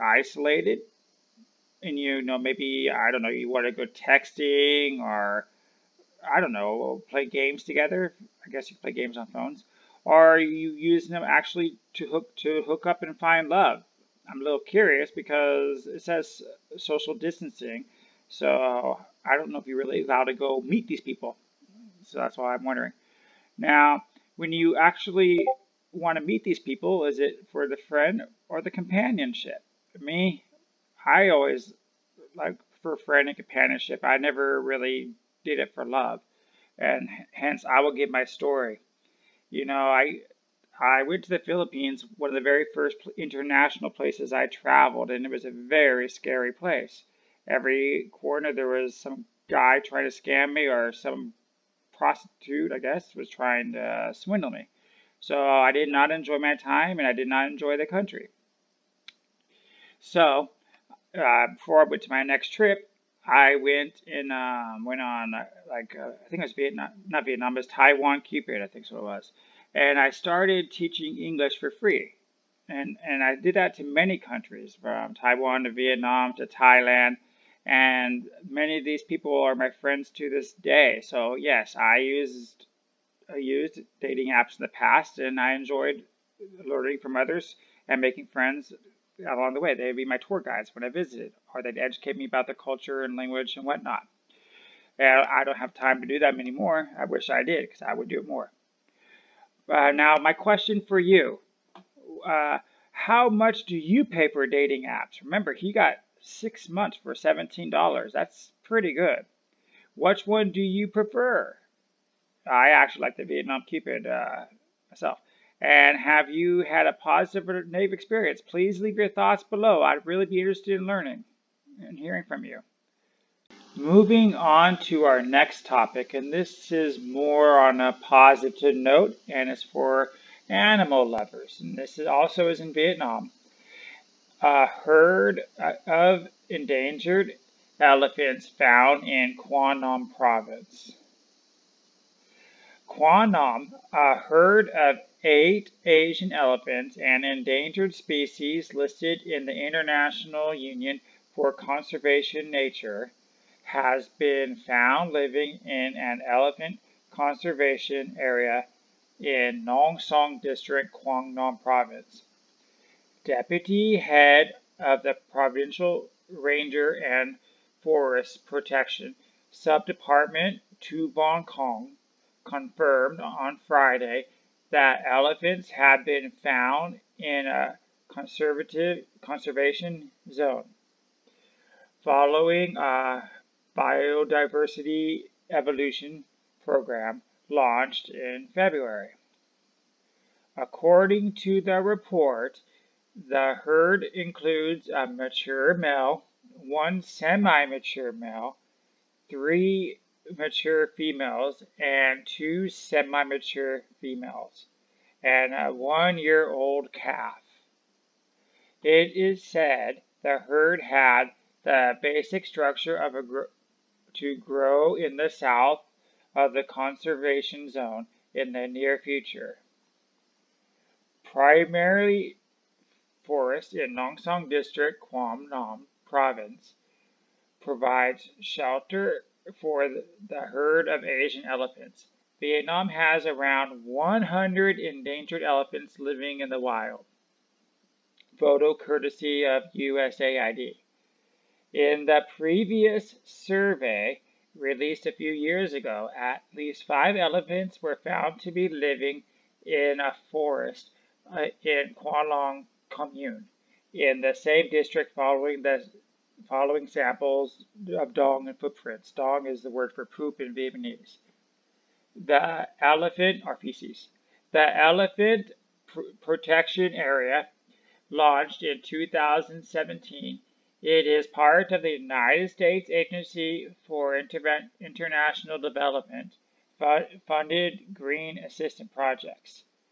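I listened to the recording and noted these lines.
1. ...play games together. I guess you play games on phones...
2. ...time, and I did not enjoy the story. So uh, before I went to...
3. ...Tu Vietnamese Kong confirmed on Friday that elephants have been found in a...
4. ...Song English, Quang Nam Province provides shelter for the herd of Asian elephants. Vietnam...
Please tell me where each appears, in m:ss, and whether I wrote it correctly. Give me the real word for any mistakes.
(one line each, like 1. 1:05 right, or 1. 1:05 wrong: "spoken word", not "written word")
1. 0:07 right
2. 0:56 wrong: "country", not "story"
3. 2:50 wrong: "Bong", not "Vietnamese"
4. 3:44 wrong: "District", not "English".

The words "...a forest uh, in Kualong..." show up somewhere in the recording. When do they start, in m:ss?
4:10.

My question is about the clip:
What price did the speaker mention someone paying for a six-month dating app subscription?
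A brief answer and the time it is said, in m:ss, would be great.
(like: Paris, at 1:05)
$17, at 1:47.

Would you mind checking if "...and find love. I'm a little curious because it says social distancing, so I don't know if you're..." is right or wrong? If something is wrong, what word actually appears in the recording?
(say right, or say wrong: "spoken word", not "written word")
right.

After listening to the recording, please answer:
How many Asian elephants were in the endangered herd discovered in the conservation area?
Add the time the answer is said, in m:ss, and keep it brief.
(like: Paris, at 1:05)
8, at 2:25.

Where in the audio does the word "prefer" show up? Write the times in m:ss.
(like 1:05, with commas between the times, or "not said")
1:50.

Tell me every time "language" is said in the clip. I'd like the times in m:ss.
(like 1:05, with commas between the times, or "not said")
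1:33.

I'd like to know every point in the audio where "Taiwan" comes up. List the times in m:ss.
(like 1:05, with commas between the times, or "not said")
1:07, 1:15.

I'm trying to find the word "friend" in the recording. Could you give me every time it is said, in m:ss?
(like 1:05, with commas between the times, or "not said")
0:27, 0:32, 1:19, 1:28.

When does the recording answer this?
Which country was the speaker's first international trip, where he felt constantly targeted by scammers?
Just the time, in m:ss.
0:41.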